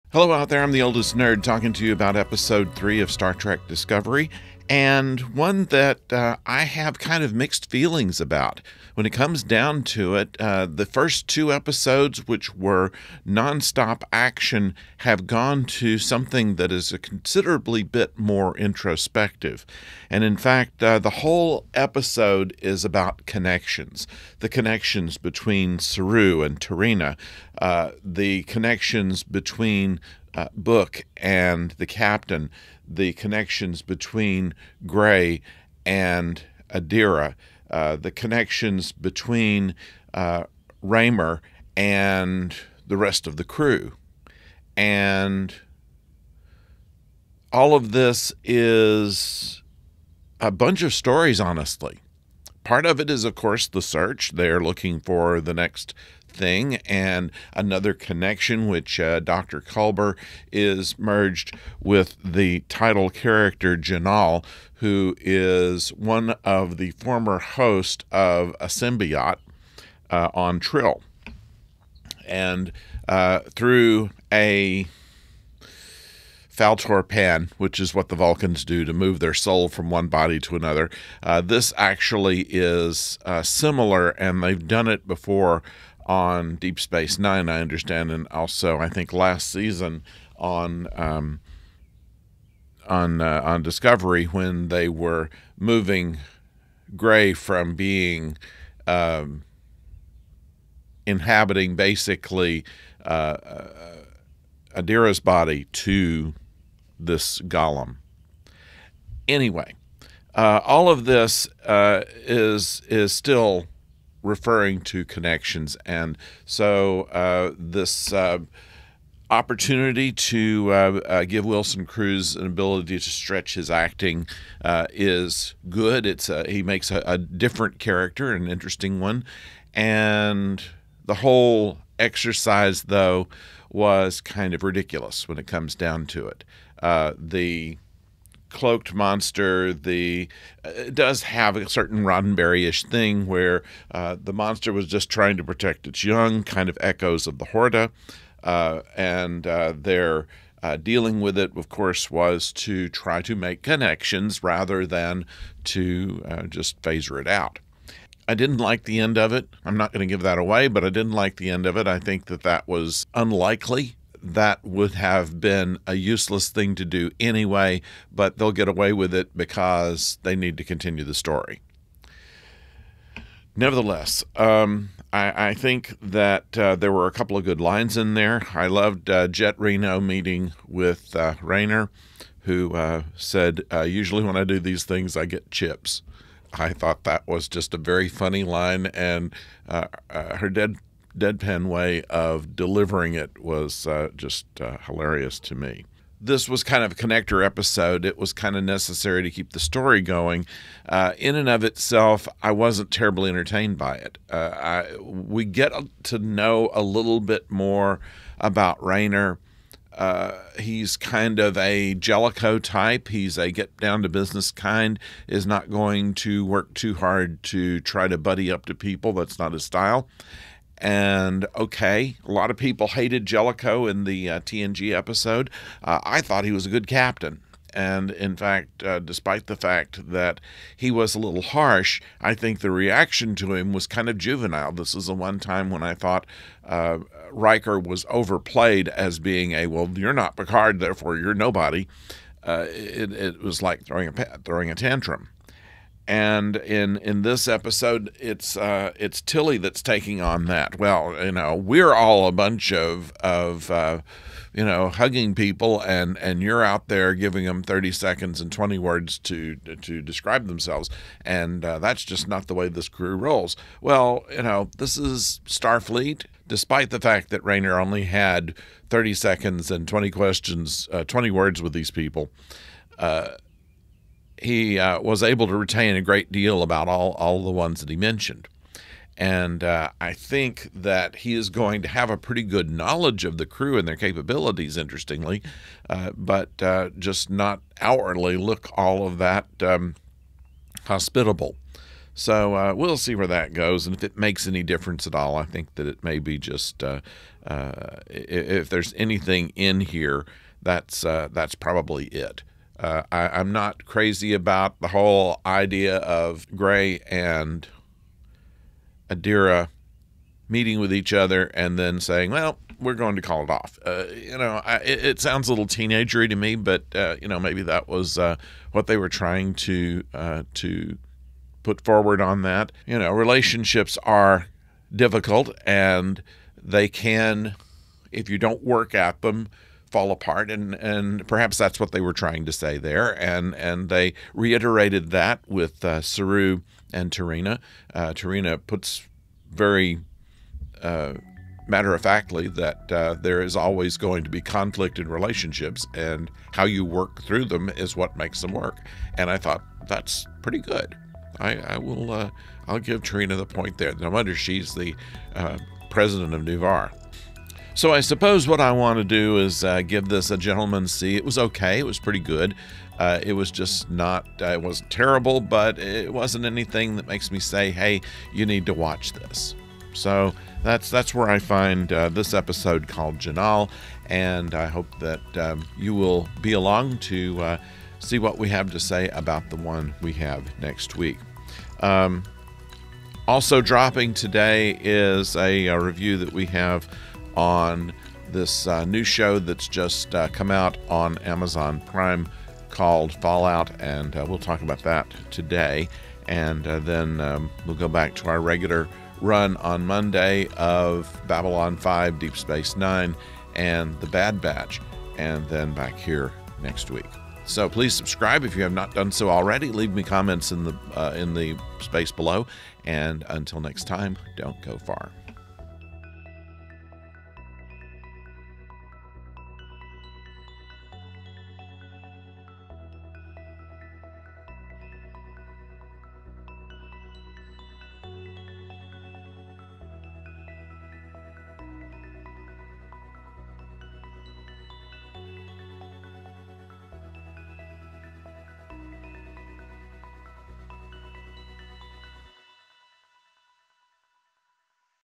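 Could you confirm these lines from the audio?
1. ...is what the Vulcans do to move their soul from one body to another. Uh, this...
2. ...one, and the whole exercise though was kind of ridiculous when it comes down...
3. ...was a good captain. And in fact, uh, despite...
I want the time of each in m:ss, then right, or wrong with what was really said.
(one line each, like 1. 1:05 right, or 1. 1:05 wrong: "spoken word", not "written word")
1. 1:17 right
2. 2:08 right
3. 3:46 right.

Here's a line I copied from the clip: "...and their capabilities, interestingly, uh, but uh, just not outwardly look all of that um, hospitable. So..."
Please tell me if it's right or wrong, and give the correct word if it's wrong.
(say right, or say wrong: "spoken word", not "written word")
right.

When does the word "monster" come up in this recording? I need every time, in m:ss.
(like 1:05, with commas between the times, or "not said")
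2:18, 2:24.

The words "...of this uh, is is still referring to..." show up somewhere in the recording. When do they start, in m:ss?
1:50.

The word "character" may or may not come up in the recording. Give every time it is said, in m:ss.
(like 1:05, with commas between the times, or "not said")
1:03, 2:07.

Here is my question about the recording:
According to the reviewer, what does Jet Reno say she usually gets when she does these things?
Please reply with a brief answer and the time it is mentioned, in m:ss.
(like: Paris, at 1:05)
chips, at 3:05.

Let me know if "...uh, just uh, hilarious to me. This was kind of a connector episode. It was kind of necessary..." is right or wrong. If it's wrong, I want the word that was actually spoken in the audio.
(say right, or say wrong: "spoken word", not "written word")
right.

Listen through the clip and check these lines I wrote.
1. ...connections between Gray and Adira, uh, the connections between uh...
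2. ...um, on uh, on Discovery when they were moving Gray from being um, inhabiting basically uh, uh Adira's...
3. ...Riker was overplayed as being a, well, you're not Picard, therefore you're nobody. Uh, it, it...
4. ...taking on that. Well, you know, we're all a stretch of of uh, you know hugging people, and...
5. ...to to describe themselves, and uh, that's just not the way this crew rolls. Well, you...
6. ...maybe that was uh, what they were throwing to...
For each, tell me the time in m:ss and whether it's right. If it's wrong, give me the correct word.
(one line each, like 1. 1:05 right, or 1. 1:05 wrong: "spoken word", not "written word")
1. 0:33 right
2. 1:30 right
3. 3:57 right
4. 4:09 wrong: "bunch", not "stretch"
5. 4:19 right
6. 5:17 wrong: "trying", not "throwing".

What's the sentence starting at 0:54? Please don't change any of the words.
They're looking for the next thing and another connection, which uh, Dr.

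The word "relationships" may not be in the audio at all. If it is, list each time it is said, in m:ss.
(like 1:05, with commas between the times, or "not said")
5:23, 5:45.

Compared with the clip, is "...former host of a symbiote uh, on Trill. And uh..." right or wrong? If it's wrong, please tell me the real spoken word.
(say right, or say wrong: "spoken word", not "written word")
right.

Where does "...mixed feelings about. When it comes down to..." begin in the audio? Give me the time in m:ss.
0:07.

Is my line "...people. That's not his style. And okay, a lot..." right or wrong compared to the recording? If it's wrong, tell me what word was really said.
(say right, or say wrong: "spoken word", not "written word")
right.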